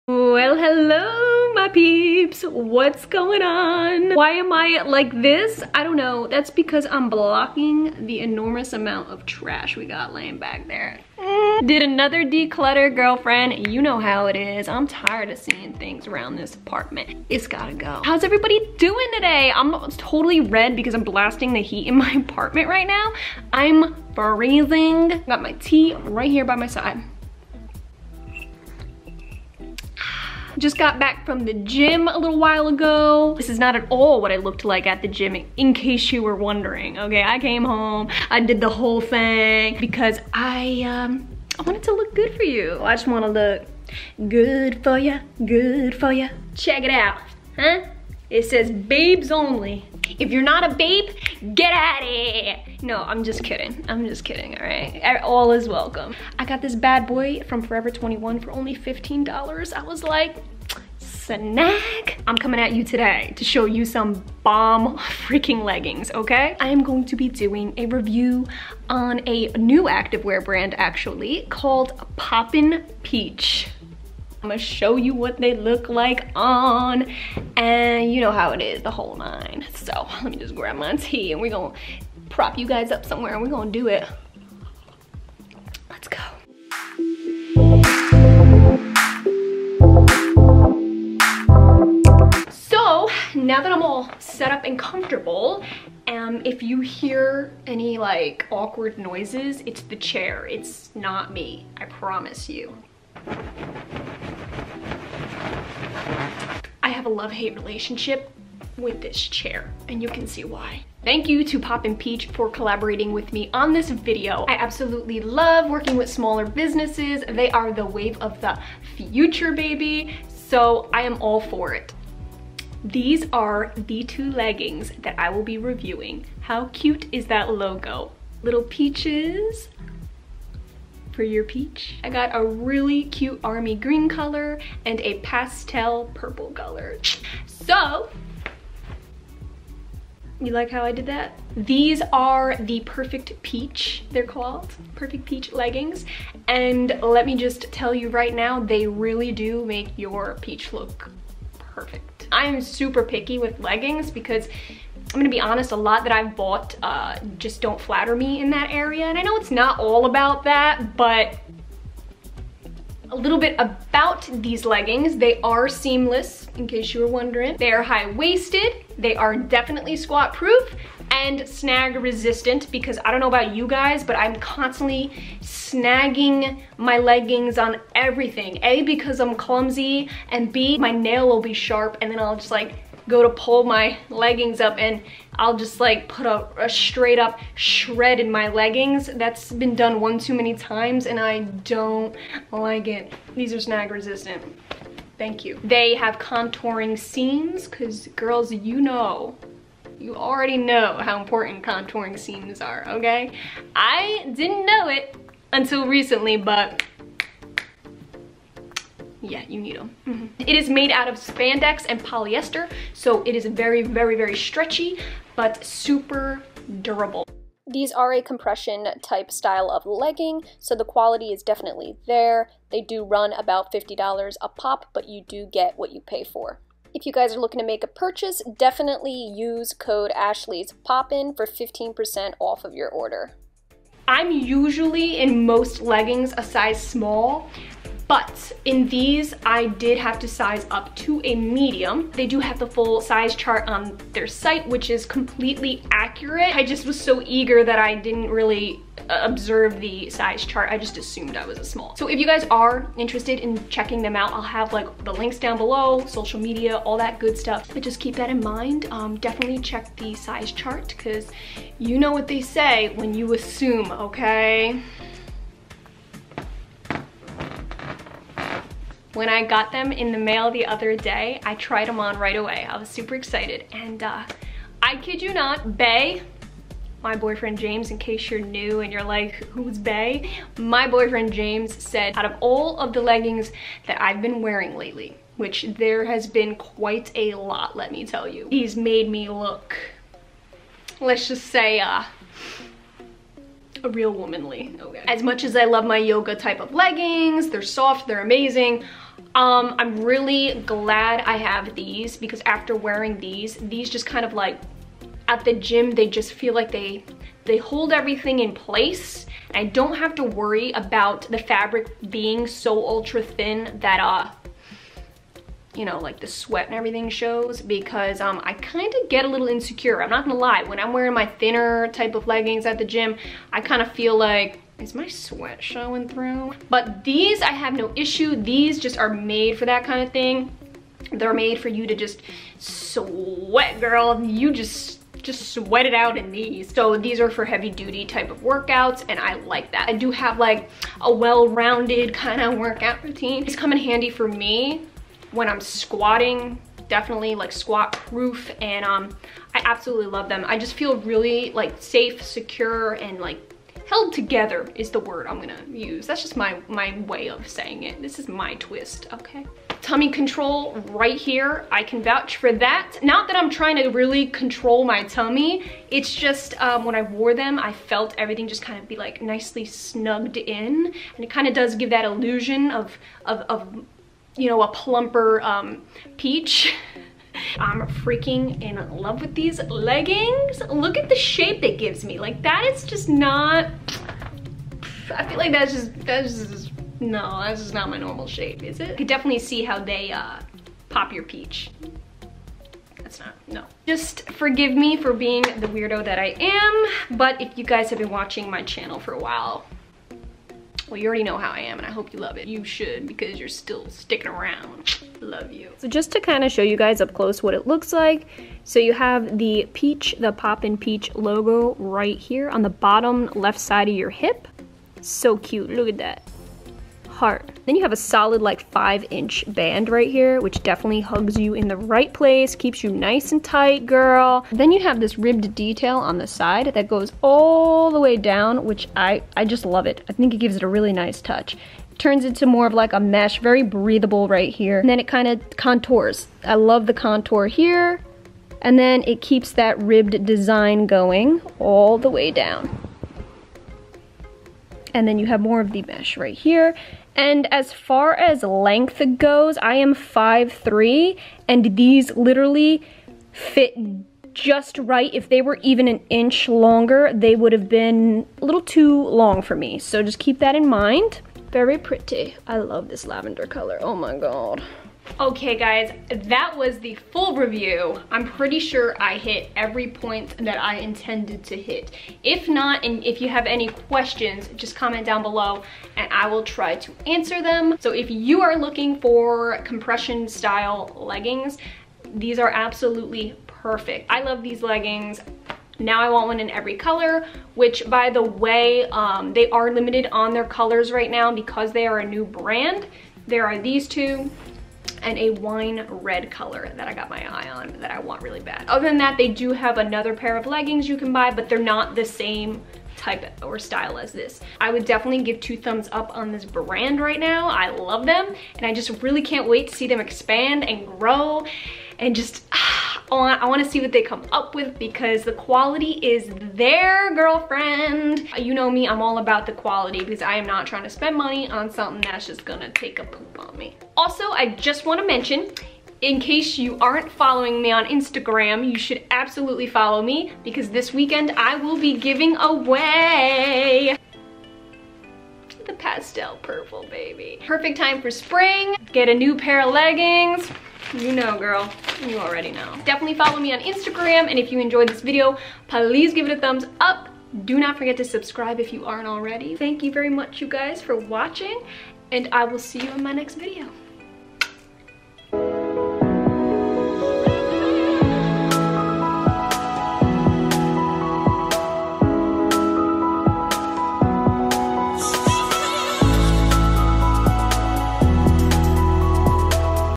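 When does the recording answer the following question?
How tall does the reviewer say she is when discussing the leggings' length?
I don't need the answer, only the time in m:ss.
7:29.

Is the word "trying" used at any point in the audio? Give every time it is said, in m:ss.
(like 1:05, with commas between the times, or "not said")
6:03, 8:40.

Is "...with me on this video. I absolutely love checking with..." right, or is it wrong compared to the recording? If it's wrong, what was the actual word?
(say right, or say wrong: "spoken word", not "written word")
wrong: "working", not "checking".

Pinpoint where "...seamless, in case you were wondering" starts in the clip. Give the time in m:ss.
2:45.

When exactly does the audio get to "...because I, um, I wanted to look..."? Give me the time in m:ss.
0:39.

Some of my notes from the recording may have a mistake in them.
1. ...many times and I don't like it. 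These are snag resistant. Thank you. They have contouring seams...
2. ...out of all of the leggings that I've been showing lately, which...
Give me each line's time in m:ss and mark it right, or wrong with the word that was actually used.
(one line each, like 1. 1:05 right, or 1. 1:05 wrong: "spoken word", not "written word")
1. 3:10 right
2. 4:42 wrong: "wearing", not "showing".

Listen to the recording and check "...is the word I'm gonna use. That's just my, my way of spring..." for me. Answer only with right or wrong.
wrong.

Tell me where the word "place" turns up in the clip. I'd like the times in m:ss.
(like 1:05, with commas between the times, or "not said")
5:08, 7:02.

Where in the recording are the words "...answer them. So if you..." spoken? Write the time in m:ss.
7:57.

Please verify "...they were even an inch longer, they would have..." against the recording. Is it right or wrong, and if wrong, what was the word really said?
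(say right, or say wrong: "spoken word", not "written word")
right.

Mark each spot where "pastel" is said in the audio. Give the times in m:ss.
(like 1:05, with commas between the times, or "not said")
2:15, 8:55.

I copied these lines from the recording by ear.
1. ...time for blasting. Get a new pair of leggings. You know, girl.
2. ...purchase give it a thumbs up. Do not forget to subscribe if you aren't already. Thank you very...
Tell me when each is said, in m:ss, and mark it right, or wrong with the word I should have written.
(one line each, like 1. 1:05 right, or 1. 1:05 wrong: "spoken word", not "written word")
1. 8:57 wrong: "spring", not "blasting"
2. 9:05 wrong: "please", not "purchase".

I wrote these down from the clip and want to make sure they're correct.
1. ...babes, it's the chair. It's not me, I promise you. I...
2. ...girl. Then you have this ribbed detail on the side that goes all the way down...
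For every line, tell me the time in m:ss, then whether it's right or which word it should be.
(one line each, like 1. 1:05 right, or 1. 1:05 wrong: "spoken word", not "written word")
1. 1:38 wrong: "noises", not "babes"
2. 7:03 right.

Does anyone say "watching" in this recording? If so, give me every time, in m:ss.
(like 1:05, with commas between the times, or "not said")
6:38, 9:10.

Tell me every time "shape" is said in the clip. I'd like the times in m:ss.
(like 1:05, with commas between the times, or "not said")
6:21, 6:28.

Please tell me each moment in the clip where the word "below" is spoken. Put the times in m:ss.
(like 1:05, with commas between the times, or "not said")
4:15, 7:55.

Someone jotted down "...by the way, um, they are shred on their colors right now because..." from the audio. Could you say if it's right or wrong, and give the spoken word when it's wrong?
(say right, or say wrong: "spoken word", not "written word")
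wrong: "limited", not "shred".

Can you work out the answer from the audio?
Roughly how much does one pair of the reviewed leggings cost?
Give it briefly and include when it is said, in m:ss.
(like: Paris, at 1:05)
$50, at 3:43.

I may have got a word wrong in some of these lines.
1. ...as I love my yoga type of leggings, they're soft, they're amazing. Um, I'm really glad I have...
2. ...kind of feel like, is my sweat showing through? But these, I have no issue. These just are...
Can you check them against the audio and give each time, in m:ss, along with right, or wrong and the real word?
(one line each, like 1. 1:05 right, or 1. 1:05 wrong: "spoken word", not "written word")
1. 4:55 right
2. 5:23 right.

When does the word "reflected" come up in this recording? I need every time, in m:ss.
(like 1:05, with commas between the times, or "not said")
not said.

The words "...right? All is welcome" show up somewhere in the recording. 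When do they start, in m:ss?
0:54.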